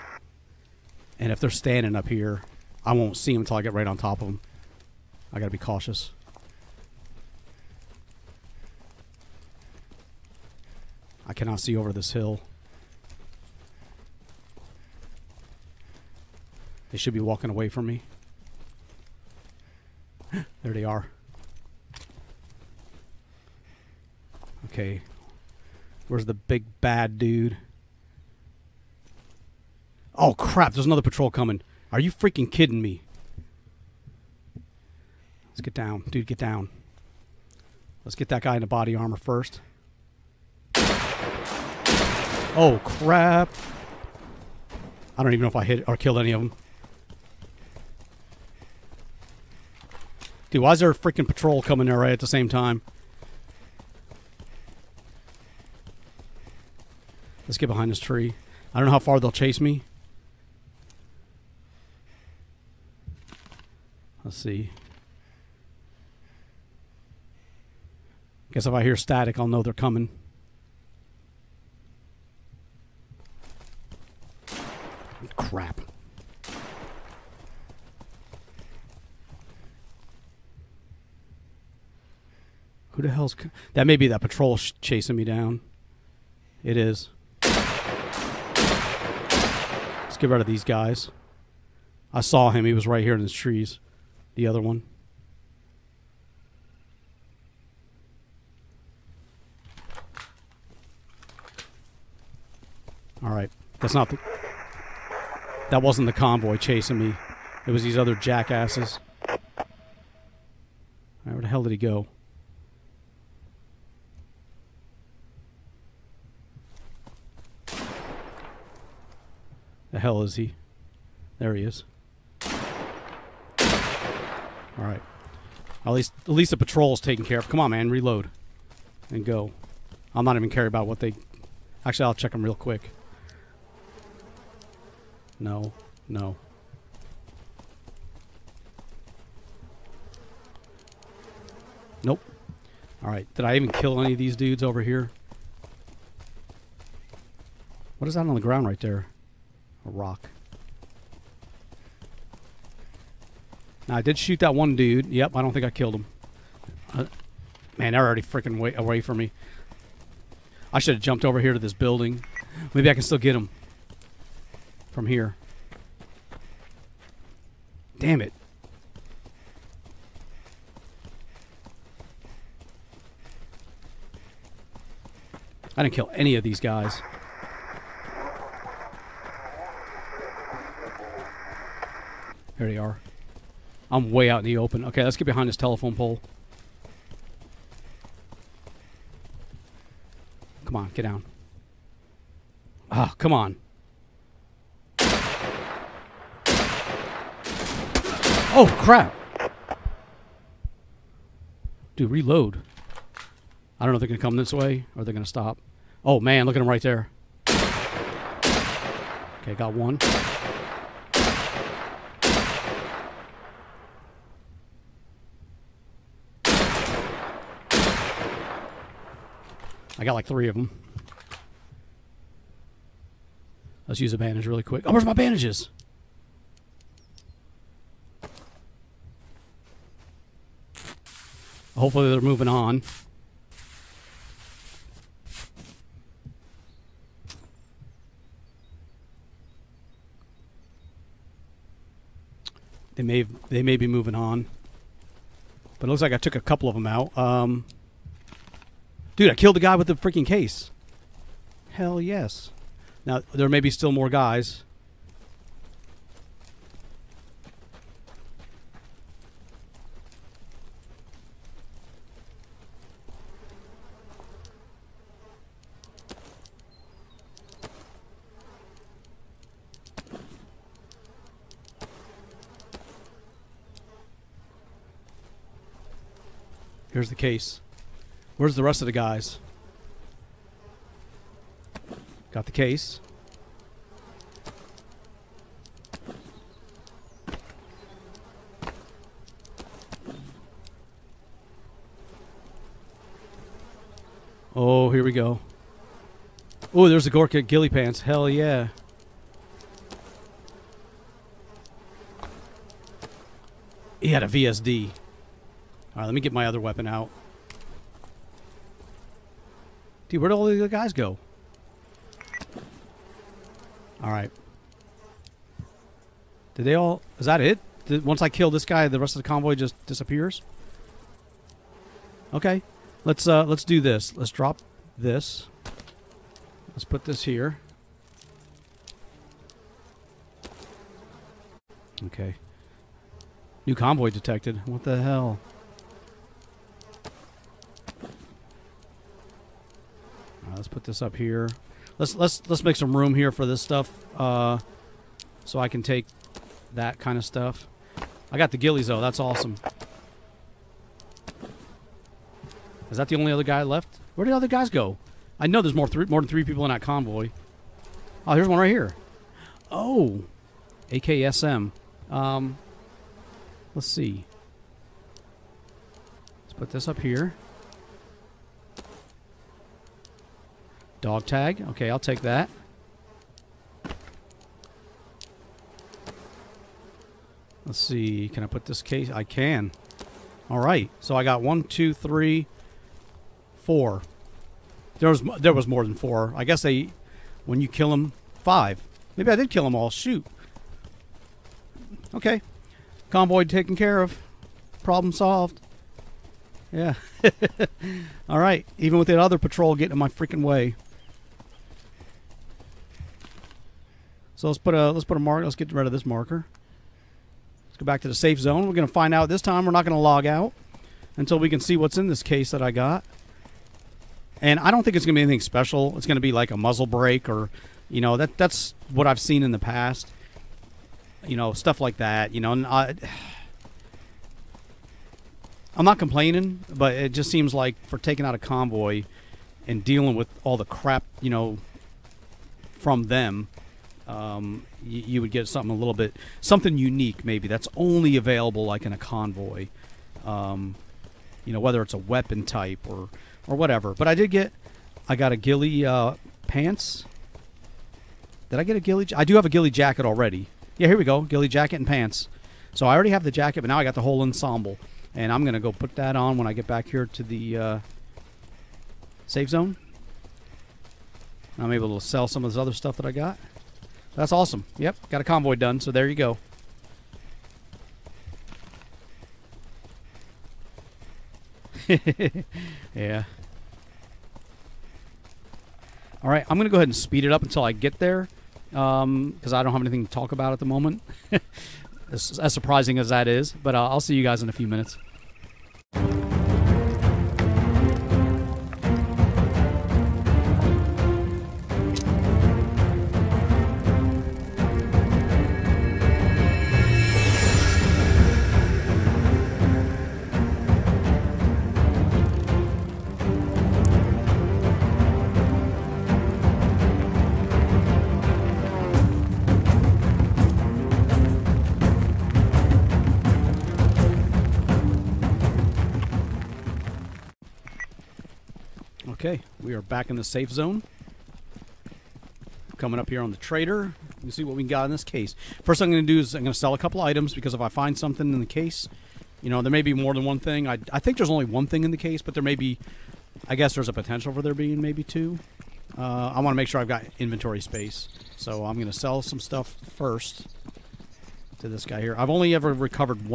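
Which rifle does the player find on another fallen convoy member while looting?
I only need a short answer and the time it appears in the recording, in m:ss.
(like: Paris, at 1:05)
AKSM, at 6:00.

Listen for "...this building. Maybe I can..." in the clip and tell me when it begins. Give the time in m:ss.
2:41.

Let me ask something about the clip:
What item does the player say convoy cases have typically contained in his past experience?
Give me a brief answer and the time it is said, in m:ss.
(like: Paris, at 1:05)
A muzzle brake, at 6:56.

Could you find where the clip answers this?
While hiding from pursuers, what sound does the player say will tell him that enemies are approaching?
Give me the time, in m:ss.
1:08.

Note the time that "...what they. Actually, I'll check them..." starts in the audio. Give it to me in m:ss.
2:10.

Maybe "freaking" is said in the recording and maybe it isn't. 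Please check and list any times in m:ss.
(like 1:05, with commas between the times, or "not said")
0:32, 0:50, 2:38, 4:09, 6:40.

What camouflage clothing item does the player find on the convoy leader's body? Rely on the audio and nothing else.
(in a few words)
Gorka Ghillie Pants.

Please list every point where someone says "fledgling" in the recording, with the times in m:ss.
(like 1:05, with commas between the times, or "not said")
not said.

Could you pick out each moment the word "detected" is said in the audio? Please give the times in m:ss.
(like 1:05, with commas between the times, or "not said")
5:34.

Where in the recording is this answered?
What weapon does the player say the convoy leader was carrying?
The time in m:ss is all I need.
5:04.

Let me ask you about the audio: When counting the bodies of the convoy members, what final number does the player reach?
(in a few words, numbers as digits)
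5.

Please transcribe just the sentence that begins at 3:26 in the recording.
Oh, man, look at them right there.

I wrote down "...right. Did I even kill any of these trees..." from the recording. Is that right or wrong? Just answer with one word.
wrong.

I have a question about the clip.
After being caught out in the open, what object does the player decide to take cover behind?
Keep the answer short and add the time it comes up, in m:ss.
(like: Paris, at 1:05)
Telephone pole, at 3:05.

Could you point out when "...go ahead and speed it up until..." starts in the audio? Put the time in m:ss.
7:56.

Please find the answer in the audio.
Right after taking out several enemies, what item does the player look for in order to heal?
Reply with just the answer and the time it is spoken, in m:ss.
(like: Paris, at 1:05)
Bandages, at 3:45.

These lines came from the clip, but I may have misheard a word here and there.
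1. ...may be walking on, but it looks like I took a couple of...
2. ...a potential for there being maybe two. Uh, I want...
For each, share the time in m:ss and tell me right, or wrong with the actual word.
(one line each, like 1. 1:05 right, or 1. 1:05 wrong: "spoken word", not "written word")
1. 4:03 wrong: "moving", not "walking"
2. 8:53 right.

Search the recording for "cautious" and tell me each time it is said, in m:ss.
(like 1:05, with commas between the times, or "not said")
0:05.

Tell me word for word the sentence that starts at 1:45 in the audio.
That wasn't the convoy chasing me.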